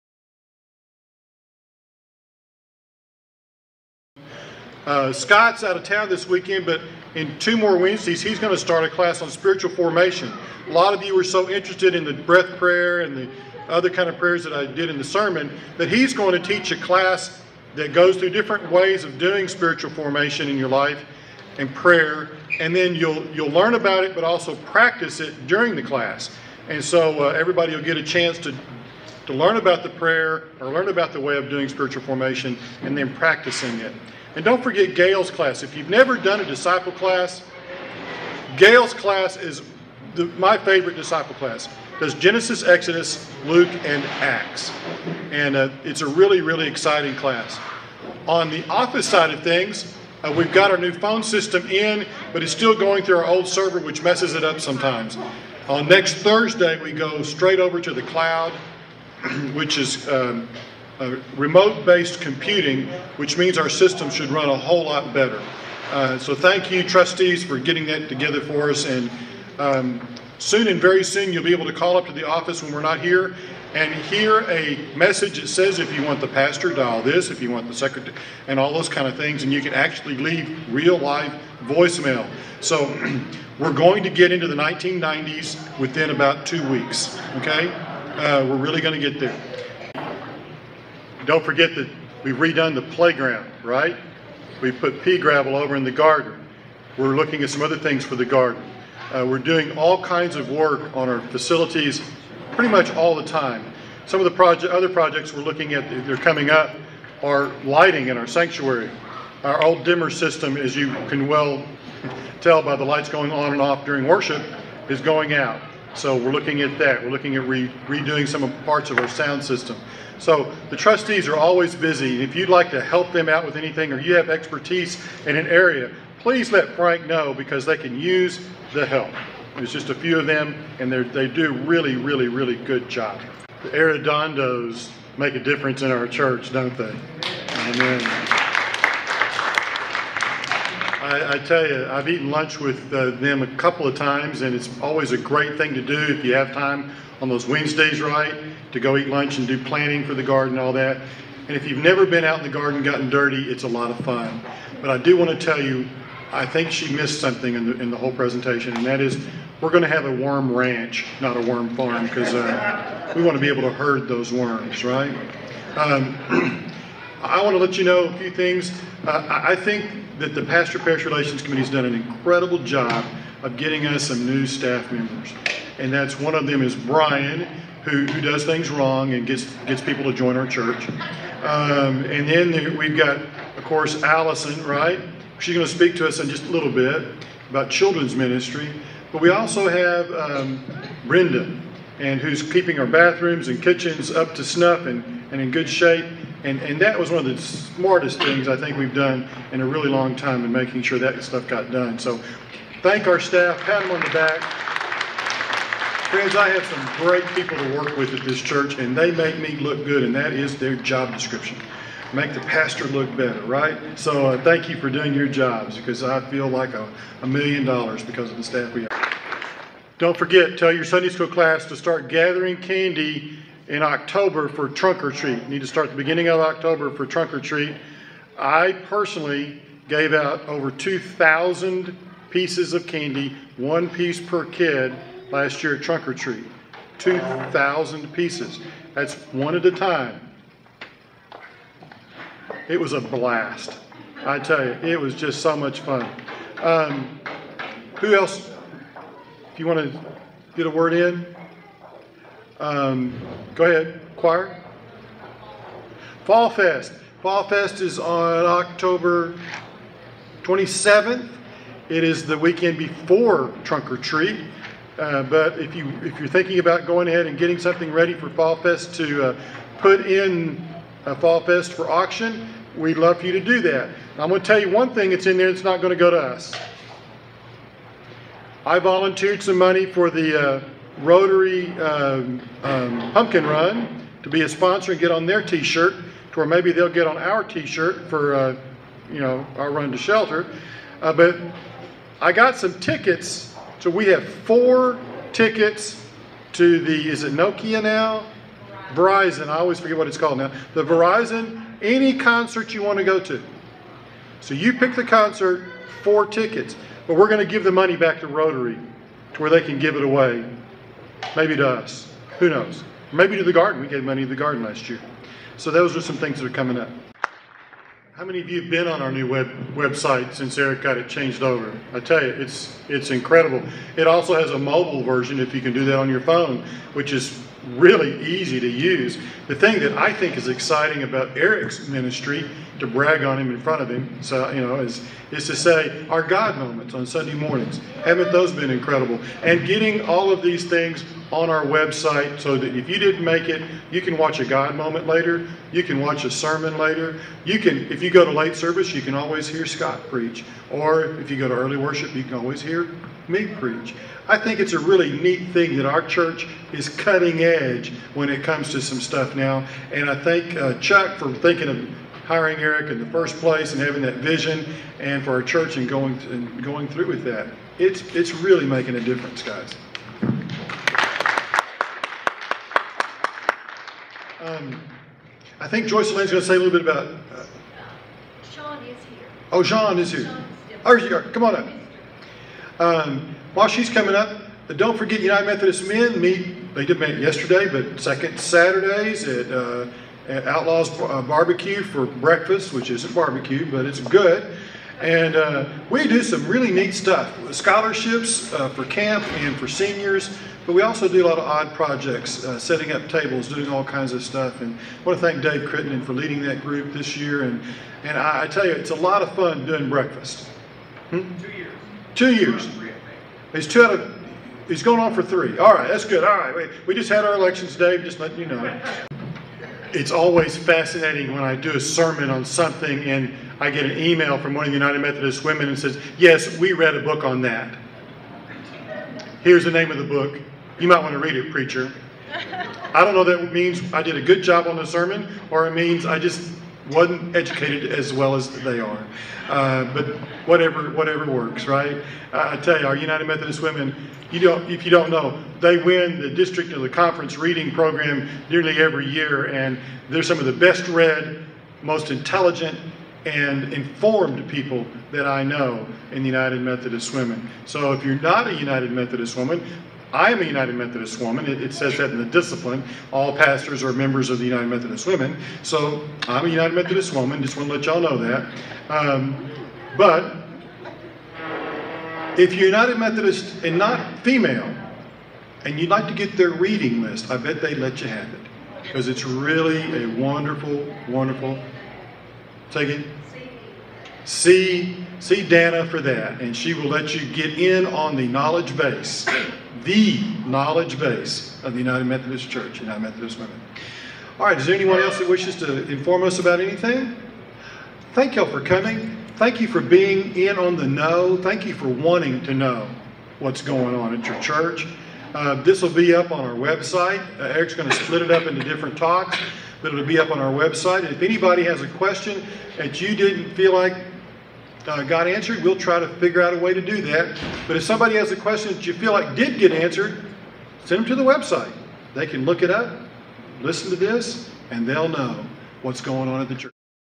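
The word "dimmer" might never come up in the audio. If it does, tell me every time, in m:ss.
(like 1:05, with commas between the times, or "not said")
1:49.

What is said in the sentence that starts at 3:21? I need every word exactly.
So thank our staff, pat them on the back.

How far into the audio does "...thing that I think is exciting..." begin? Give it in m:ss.
5:29.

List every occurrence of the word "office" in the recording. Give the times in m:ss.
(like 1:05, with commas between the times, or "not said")
0:48, 1:12.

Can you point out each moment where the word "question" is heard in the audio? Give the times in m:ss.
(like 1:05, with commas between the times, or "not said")
8:31, 8:38.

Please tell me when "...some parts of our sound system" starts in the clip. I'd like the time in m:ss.
1:58.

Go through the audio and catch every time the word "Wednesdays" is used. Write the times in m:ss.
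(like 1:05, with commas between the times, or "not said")
0:07, 2:27.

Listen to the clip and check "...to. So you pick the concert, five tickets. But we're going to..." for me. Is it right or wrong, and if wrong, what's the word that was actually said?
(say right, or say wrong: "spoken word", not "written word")
wrong: "four", not "five".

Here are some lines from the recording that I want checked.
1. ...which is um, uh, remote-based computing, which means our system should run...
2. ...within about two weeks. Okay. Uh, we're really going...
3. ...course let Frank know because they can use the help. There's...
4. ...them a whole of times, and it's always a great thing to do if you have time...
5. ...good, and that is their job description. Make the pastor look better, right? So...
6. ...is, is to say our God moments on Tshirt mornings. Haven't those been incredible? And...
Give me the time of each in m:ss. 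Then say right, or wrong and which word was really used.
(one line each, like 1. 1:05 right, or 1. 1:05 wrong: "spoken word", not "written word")
1. 0:59 right
2. 1:25 right
3. 2:06 wrong: "please", not "course"
4. 2:23 wrong: "couple", not "whole"
5. 3:29 right
6. 5:34 wrong: "Sunday", not "Tshirt".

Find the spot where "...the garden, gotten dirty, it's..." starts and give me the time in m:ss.
2:32.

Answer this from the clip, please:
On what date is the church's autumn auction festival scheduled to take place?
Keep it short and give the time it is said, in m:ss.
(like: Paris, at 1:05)
October 27th, at 4:18.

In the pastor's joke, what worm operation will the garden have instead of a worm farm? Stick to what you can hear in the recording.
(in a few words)
worm ranch.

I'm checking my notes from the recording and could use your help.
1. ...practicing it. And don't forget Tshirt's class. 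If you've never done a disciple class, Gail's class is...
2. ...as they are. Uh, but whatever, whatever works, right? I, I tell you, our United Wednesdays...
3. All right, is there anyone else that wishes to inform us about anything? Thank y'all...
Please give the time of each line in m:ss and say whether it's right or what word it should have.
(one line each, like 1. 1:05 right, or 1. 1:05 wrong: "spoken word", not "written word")
1. 0:33 wrong: "Gail", not "Tshirt"
2. 7:18 wrong: "Methodist", not "Wednesdays"
3. 8:14 right.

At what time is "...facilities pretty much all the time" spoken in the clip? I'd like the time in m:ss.
1:41.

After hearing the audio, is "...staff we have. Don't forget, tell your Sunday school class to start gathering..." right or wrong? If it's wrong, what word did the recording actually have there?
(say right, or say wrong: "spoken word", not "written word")
right.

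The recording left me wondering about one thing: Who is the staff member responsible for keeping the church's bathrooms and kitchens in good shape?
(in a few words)
Brenda.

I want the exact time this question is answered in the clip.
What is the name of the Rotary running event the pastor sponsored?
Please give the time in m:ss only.
4:43.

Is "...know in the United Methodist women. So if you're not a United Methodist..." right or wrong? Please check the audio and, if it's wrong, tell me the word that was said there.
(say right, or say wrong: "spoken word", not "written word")
right.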